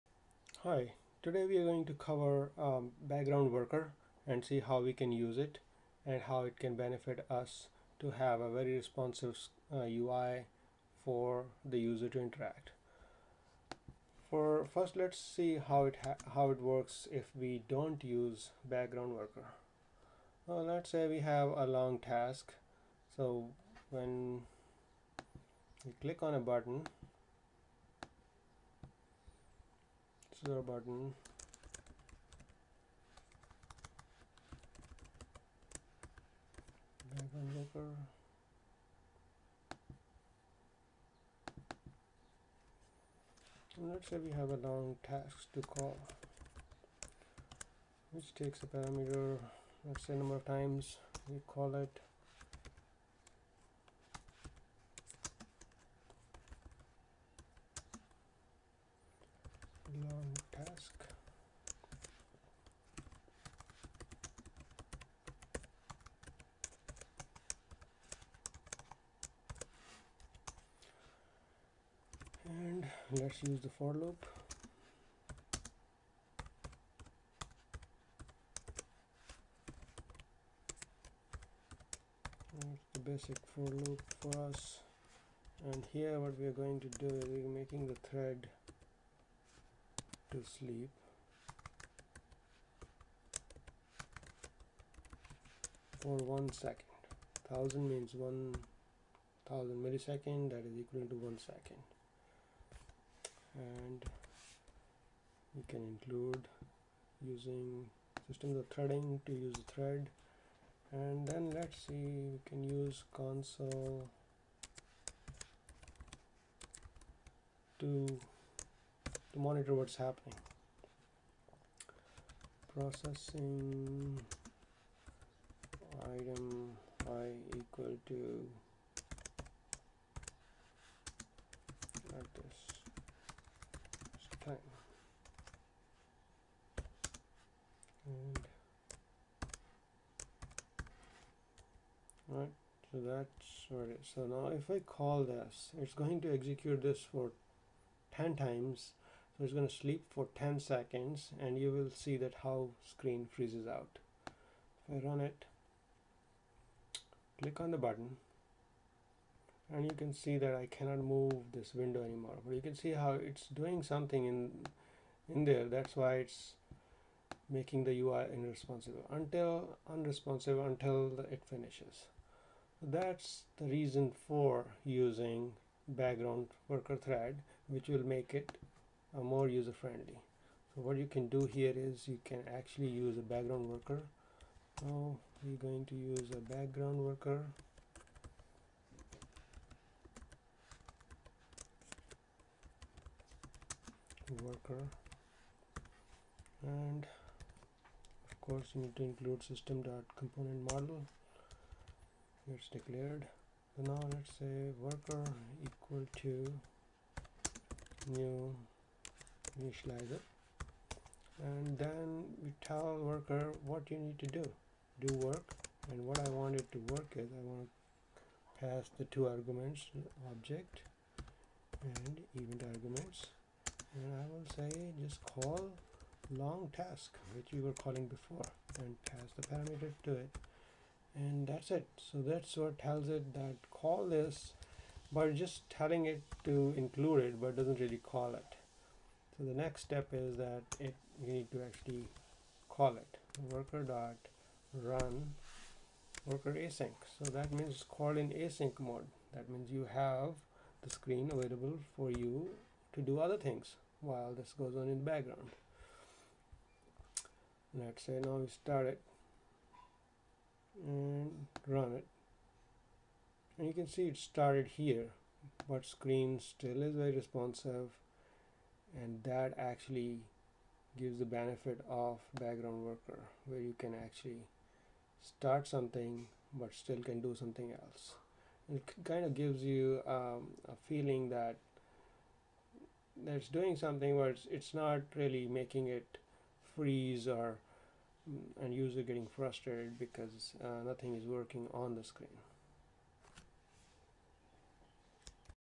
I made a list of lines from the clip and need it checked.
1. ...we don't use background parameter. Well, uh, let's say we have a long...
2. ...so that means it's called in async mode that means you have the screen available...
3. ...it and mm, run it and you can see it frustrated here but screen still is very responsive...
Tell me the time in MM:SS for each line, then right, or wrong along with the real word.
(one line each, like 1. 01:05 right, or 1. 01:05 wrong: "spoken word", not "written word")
1. 00:17 wrong: "worker", not "parameter"
2. 04:07 right
3. 04:18 wrong: "started", not "frustrated".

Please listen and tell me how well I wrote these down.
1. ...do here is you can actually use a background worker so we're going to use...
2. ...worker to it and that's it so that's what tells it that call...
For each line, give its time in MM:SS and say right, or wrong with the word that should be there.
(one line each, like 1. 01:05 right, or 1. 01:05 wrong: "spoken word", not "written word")
1. 03:01 right
2. 03:49 wrong: "parameter", not "worker".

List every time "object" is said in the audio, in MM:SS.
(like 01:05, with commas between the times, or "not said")
03:40.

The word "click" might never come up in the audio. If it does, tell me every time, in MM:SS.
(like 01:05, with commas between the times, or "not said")
00:25, 02:37.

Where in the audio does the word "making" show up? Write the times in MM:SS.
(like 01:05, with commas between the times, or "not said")
01:27, 02:47, 04:45.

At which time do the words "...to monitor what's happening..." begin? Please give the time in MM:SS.
01:59.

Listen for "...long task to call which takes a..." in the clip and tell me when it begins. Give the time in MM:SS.
00:44.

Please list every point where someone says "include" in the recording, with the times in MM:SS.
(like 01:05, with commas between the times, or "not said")
01:45, 03:19, 03:56.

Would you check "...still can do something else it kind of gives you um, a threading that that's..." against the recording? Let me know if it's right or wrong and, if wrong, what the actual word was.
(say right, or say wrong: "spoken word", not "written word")
wrong: "feeling", not "threading".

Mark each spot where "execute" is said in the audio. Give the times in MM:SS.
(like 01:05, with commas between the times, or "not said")
02:26.